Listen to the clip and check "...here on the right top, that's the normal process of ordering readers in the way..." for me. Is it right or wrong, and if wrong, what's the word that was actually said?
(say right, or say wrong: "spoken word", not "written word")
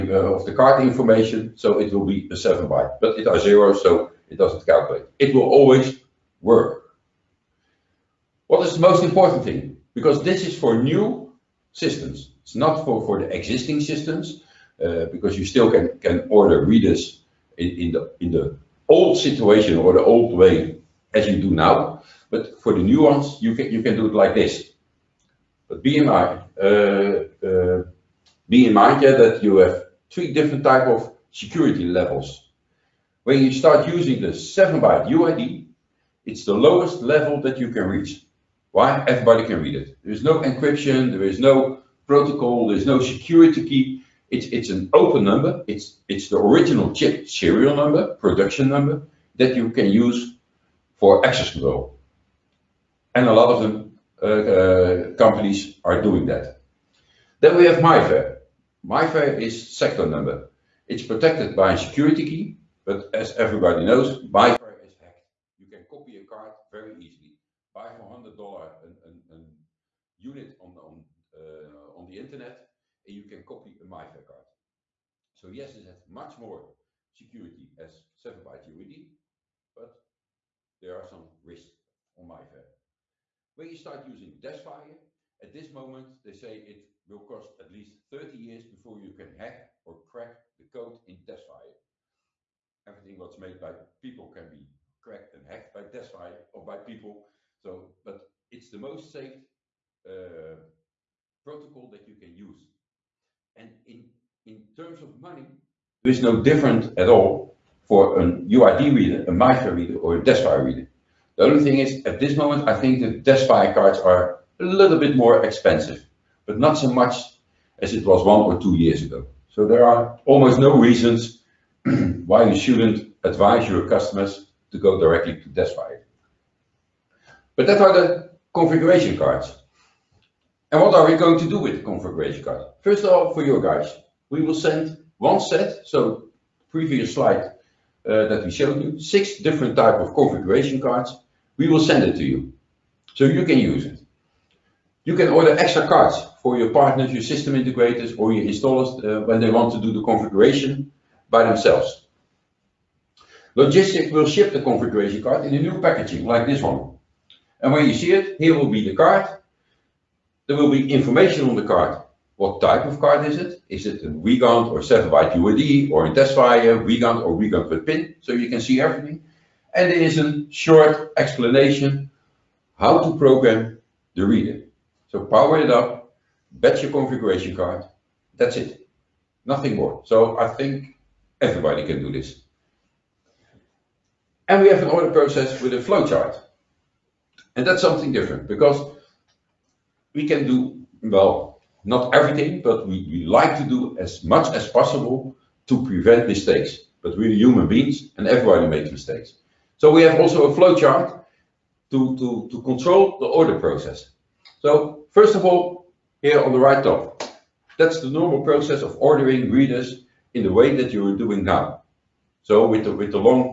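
right.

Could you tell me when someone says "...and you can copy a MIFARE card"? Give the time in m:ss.
1:13.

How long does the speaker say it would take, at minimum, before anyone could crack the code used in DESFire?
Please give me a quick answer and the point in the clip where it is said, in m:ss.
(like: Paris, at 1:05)
30 years, at 1:28.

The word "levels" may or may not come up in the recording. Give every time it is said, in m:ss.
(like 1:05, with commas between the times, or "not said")
0:31, 0:37.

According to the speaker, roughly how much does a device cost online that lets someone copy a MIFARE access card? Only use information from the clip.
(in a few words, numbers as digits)
$100.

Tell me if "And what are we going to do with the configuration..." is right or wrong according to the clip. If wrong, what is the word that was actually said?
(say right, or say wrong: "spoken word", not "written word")
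right.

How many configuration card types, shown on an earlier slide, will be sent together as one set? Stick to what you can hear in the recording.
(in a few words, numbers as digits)
6.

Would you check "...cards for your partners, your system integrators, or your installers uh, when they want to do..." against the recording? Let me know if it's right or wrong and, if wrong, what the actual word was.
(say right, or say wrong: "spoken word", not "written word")
right.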